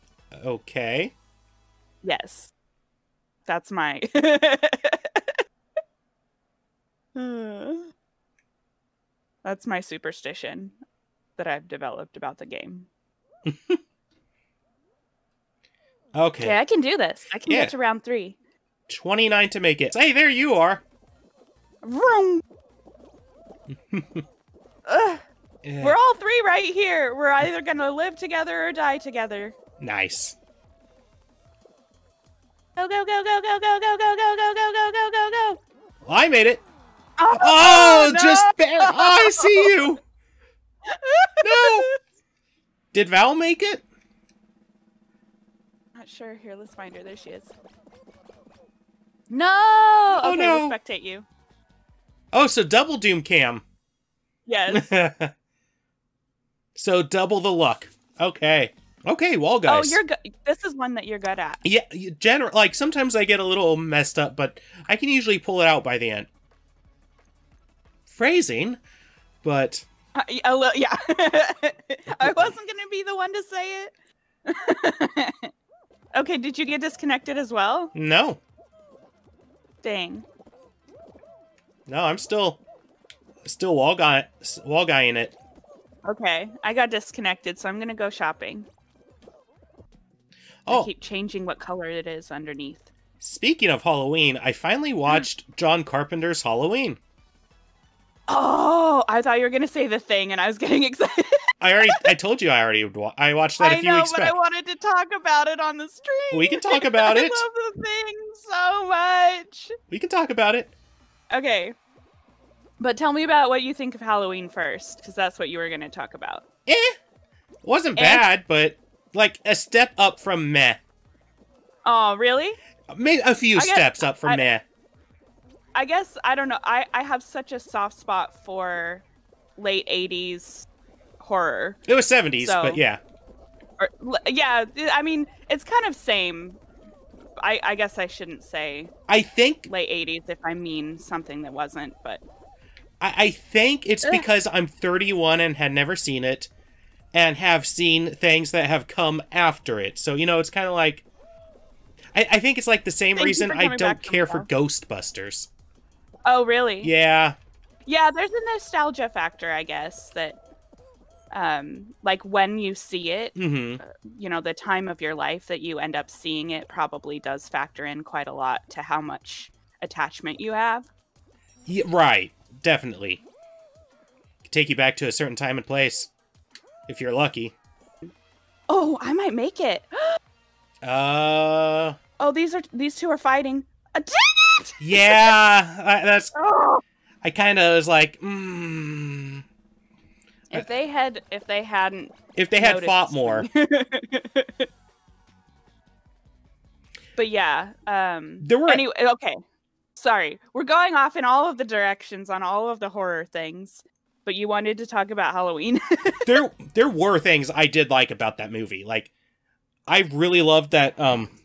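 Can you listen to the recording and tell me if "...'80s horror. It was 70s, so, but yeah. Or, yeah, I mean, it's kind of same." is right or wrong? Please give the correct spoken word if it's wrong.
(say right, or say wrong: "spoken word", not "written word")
right.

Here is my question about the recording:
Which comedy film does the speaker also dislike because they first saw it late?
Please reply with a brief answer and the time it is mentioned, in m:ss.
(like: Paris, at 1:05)
Ghostbusters, at 2:34.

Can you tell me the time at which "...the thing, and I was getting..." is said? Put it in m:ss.
1:39.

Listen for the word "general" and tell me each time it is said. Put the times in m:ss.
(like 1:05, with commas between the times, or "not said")
1:02.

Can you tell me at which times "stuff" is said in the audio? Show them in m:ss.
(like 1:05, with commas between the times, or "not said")
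not said.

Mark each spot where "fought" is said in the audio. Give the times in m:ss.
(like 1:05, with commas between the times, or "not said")
3:12.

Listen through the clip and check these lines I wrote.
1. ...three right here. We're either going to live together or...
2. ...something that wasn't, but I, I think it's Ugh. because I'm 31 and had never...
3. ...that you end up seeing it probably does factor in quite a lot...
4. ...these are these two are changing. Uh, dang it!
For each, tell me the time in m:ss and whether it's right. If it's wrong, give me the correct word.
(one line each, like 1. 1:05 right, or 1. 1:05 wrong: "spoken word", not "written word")
1. 0:26 right
2. 2:20 right
3. 2:45 right
4. 3:02 wrong: "fighting", not "changing".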